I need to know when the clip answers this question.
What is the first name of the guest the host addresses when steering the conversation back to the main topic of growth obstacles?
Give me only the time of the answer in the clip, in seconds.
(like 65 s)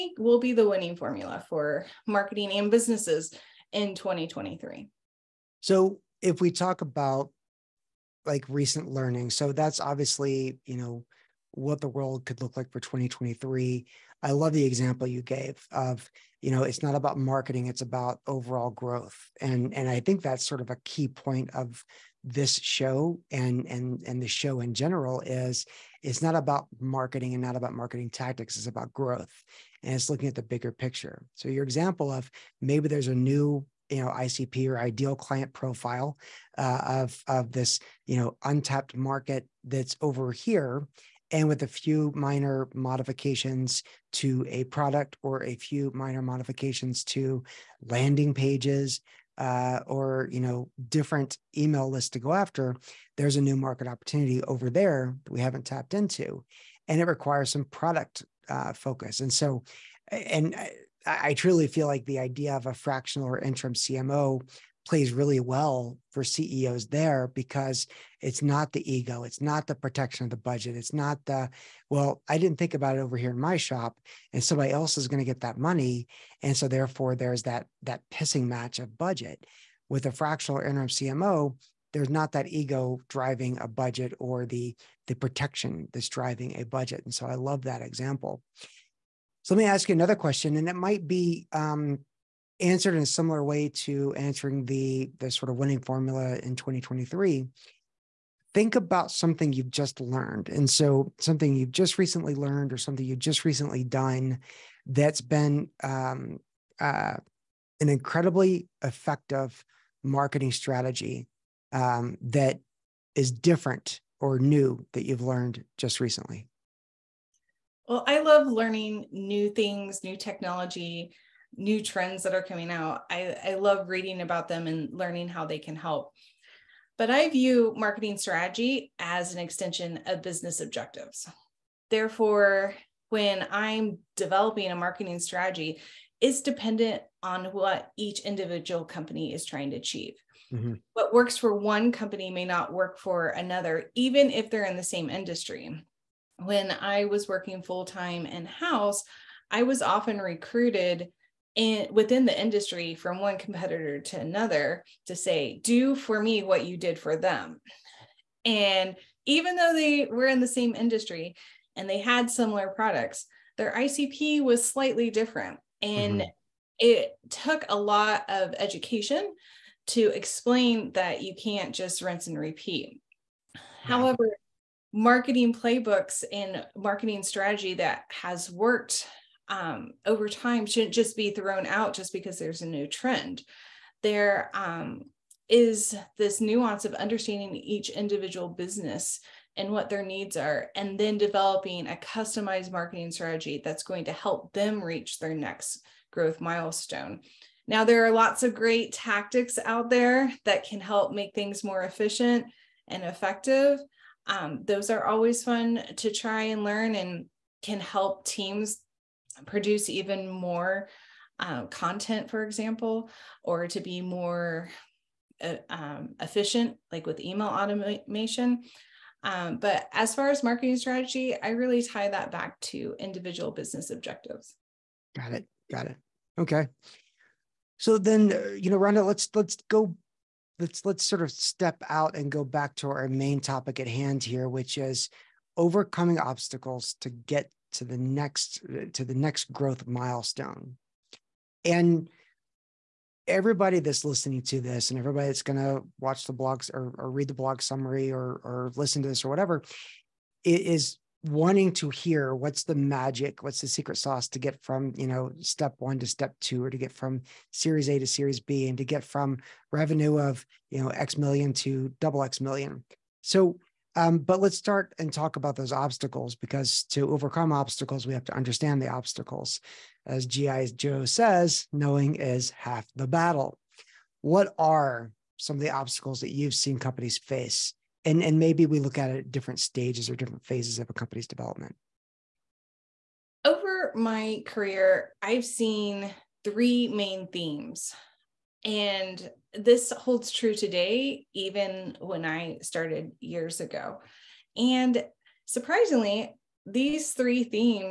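228 s.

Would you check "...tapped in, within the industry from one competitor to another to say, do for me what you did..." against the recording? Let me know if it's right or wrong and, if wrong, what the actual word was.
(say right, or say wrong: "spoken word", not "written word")
wrong: "recruited", not "tapped".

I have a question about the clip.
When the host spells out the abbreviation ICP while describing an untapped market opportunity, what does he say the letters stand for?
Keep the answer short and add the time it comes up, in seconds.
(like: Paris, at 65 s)
ideal client profile, at 34 s.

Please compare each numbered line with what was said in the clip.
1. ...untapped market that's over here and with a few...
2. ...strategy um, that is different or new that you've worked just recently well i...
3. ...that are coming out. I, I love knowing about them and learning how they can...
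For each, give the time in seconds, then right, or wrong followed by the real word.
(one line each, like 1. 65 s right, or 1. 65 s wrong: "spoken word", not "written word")
1. 38 s right
2. 110 s wrong: "learned", not "worked"
3. 122 s wrong: "reading", not "knowing".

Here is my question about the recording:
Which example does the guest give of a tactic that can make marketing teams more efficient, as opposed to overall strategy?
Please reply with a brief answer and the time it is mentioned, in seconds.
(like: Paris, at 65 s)
email automation, at 217 s.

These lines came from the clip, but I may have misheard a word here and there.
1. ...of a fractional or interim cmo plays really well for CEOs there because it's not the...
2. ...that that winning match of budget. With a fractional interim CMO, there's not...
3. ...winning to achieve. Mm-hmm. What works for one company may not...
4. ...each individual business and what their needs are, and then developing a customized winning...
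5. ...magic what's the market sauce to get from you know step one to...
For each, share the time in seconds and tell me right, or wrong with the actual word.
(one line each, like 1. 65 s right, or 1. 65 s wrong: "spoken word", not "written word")
1. 62 s right
2. 77 s wrong: "pissing", not "winning"
3. 139 s wrong: "trying", not "winning"
4. 187 s wrong: "marketing", not "winning"
5. 252 s wrong: "secret", not "market".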